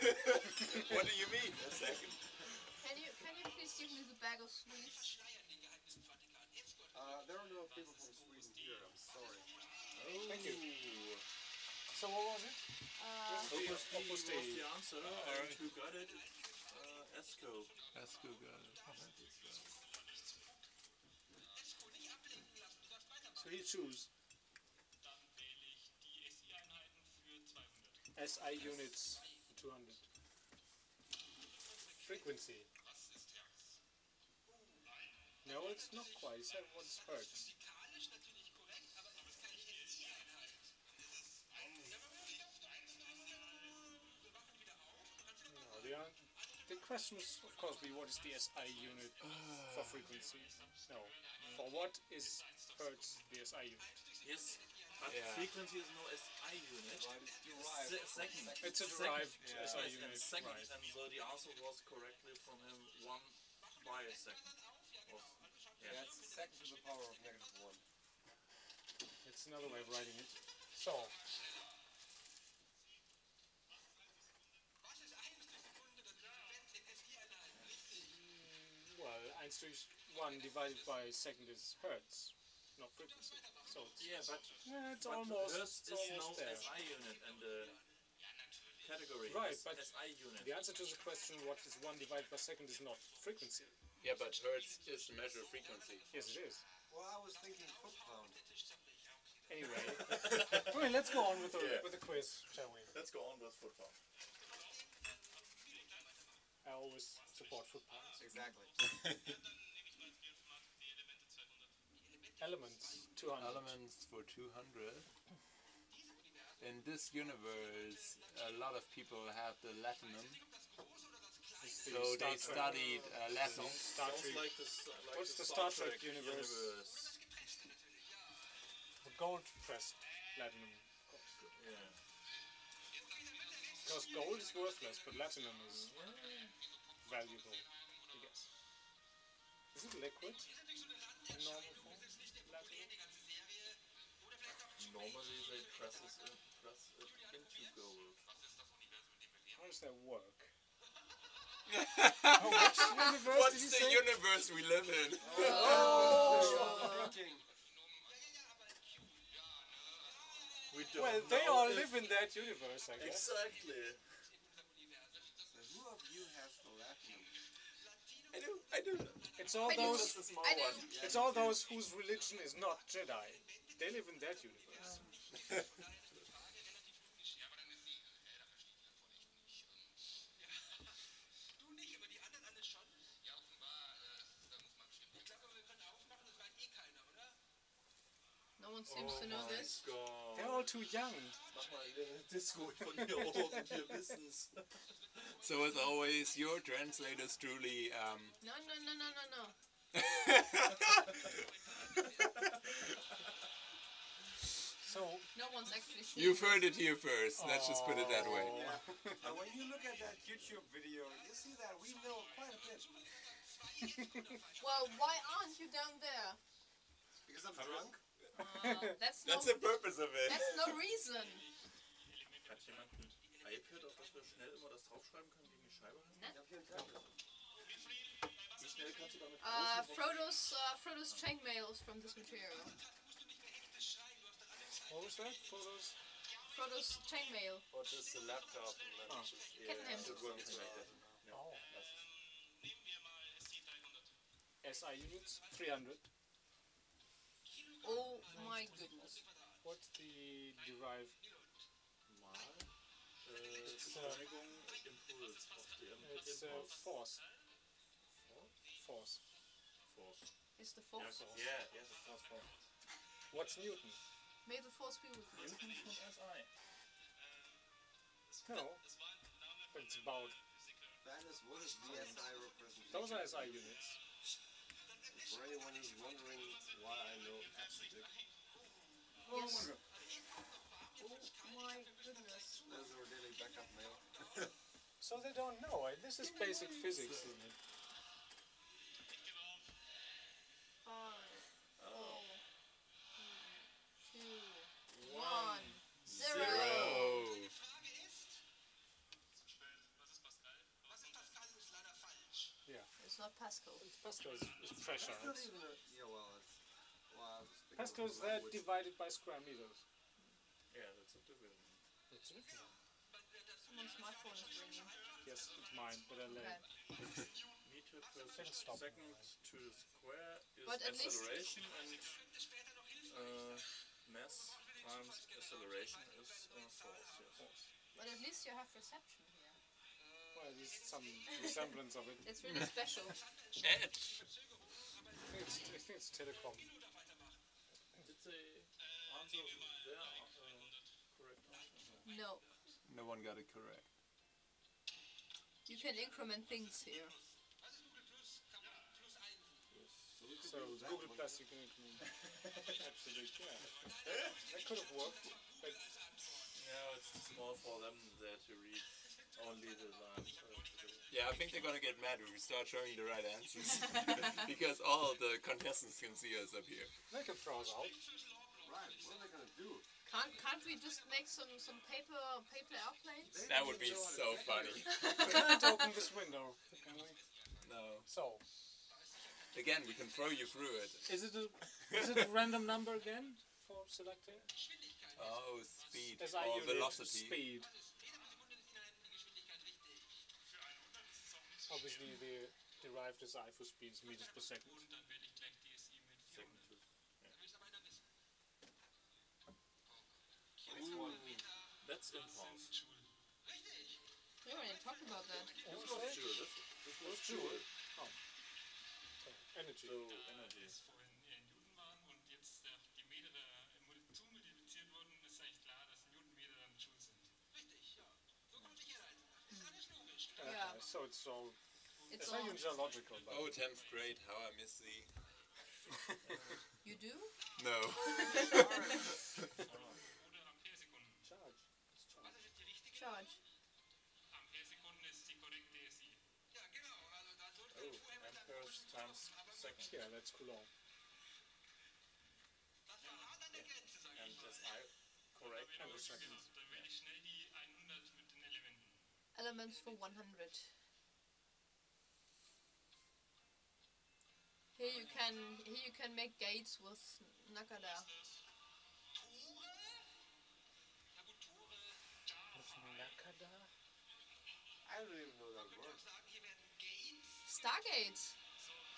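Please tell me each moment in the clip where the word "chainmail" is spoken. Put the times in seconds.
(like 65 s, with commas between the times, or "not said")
237 s.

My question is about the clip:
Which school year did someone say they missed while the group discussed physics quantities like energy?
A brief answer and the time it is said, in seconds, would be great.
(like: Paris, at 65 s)
10th grade, at 423 s.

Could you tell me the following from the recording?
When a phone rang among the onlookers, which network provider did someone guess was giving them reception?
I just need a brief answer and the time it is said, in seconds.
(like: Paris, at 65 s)
Telecom, at 336 s.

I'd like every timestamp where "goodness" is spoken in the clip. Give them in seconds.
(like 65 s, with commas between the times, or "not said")
248 s, 281 s.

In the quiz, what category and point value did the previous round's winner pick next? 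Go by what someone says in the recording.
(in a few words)
SI units 200.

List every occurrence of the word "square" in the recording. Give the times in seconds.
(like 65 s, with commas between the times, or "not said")
309 s, 319 s.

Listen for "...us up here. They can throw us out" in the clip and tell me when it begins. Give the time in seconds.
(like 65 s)
366 s.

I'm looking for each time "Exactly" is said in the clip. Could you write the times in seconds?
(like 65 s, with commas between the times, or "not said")
108 s, 163 s.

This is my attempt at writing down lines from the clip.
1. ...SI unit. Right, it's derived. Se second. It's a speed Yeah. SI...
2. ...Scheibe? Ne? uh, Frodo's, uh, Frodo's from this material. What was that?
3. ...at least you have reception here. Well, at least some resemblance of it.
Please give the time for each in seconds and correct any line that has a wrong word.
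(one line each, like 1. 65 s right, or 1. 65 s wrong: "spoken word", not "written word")
1. 56 s wrong: "derived", not "speed"
2. 225 s right
3. 328 s right.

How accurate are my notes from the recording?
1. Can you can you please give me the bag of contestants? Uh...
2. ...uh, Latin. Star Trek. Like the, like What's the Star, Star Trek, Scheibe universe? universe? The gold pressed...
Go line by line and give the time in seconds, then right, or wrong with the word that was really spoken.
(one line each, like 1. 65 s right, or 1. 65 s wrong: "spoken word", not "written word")
1. 2 s wrong: "sweets", not "contestants"
2. 123 s wrong: "Trek", not "Scheibe".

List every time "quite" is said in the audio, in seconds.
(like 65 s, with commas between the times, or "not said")
36 s, 212 s.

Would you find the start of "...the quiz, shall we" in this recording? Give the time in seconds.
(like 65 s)
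101 s.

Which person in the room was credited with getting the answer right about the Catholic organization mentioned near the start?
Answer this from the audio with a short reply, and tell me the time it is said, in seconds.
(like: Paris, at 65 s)
Esco, at 17 s.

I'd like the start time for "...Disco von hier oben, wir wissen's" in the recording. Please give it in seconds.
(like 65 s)
192 s.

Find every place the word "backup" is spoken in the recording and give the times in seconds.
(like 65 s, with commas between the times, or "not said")
283 s.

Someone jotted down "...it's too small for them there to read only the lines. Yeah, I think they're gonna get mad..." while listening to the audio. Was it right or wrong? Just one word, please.
right.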